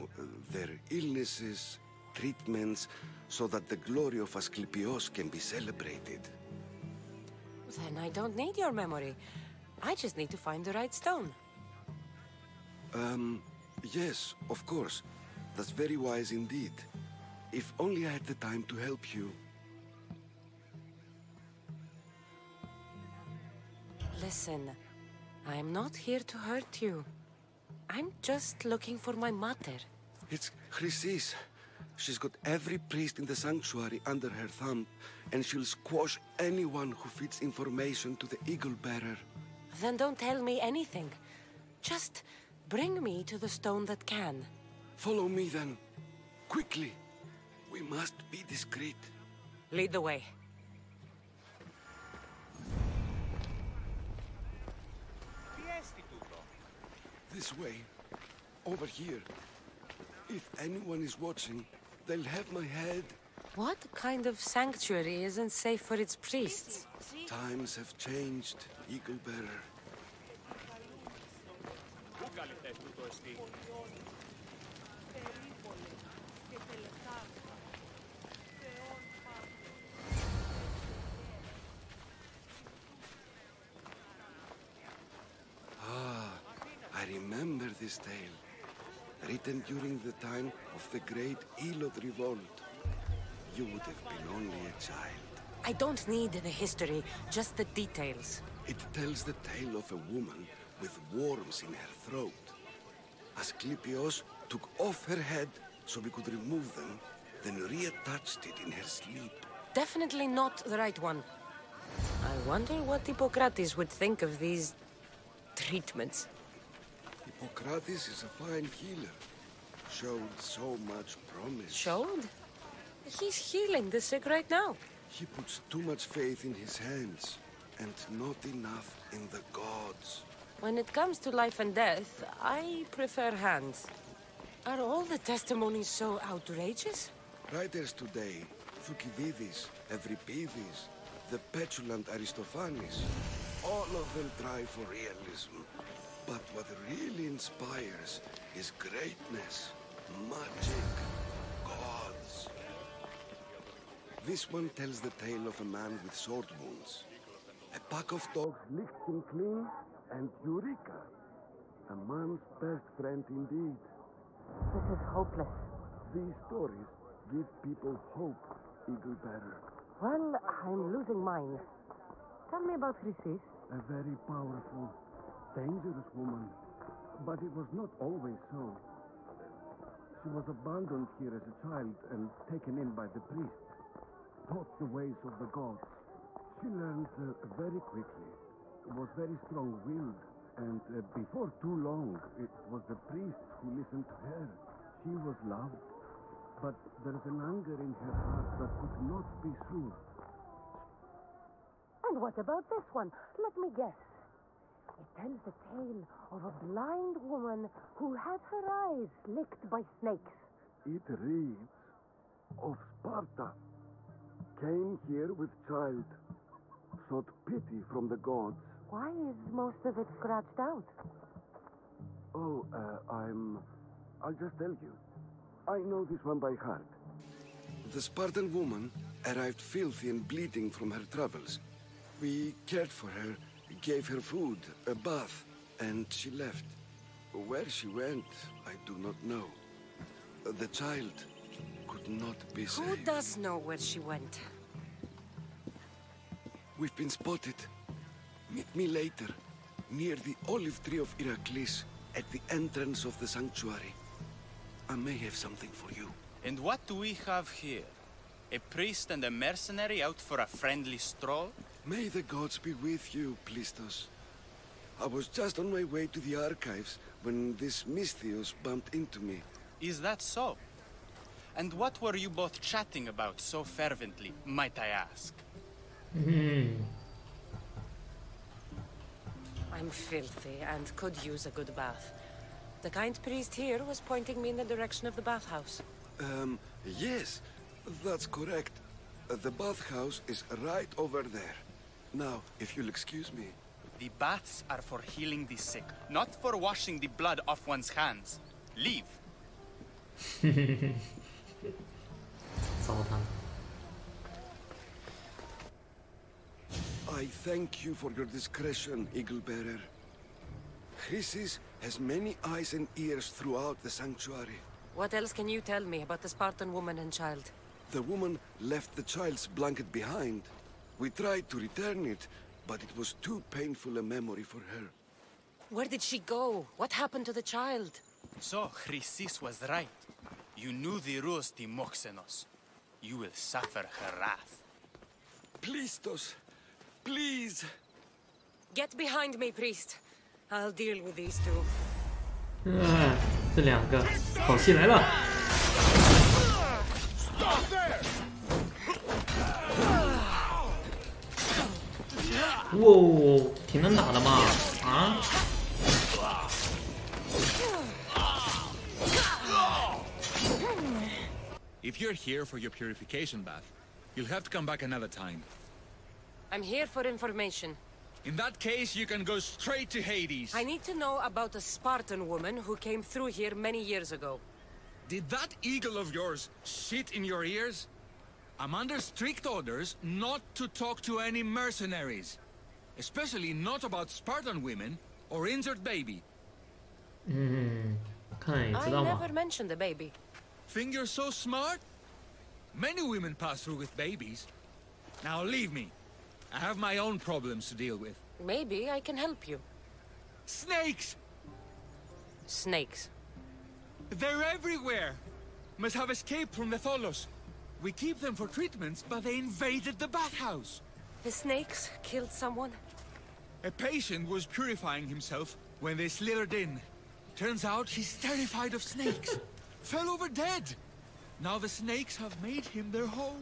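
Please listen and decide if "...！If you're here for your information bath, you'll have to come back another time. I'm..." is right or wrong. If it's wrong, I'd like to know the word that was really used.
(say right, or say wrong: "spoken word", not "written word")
wrong: "purification", not "information".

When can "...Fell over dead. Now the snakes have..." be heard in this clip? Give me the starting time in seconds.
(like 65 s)
419 s.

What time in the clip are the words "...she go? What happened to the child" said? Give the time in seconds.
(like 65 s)
326 s.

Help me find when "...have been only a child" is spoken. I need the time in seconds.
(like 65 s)
93 s.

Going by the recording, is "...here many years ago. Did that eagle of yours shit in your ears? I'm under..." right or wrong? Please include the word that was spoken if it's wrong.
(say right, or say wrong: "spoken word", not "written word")
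right.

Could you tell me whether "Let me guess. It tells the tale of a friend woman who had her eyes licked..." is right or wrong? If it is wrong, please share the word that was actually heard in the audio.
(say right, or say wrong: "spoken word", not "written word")
wrong: "blind", not "friend".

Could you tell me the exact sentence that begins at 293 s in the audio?
The baths are for healing the sick, not for washing the blood off one's hands.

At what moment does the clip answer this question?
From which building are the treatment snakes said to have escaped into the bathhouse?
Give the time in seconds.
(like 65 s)
406 s.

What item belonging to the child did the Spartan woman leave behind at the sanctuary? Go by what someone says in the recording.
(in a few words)
The child's blanket.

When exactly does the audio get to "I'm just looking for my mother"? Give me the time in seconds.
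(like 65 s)
27 s.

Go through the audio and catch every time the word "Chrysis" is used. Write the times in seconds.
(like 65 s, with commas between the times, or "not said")
30 s, 172 s, 310 s, 328 s.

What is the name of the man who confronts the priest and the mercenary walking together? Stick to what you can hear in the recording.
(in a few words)
Plistos.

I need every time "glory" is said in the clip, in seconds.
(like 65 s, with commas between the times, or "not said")
3 s.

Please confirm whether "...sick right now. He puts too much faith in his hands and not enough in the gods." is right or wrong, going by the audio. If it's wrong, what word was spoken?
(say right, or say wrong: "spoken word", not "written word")
right.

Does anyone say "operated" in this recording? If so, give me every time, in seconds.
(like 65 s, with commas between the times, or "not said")
not said.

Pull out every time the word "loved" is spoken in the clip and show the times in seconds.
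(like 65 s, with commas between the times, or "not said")
195 s.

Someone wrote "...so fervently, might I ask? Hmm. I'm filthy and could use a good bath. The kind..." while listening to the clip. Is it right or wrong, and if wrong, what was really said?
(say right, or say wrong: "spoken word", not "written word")
right.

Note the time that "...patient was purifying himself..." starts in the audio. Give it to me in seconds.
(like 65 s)
413 s.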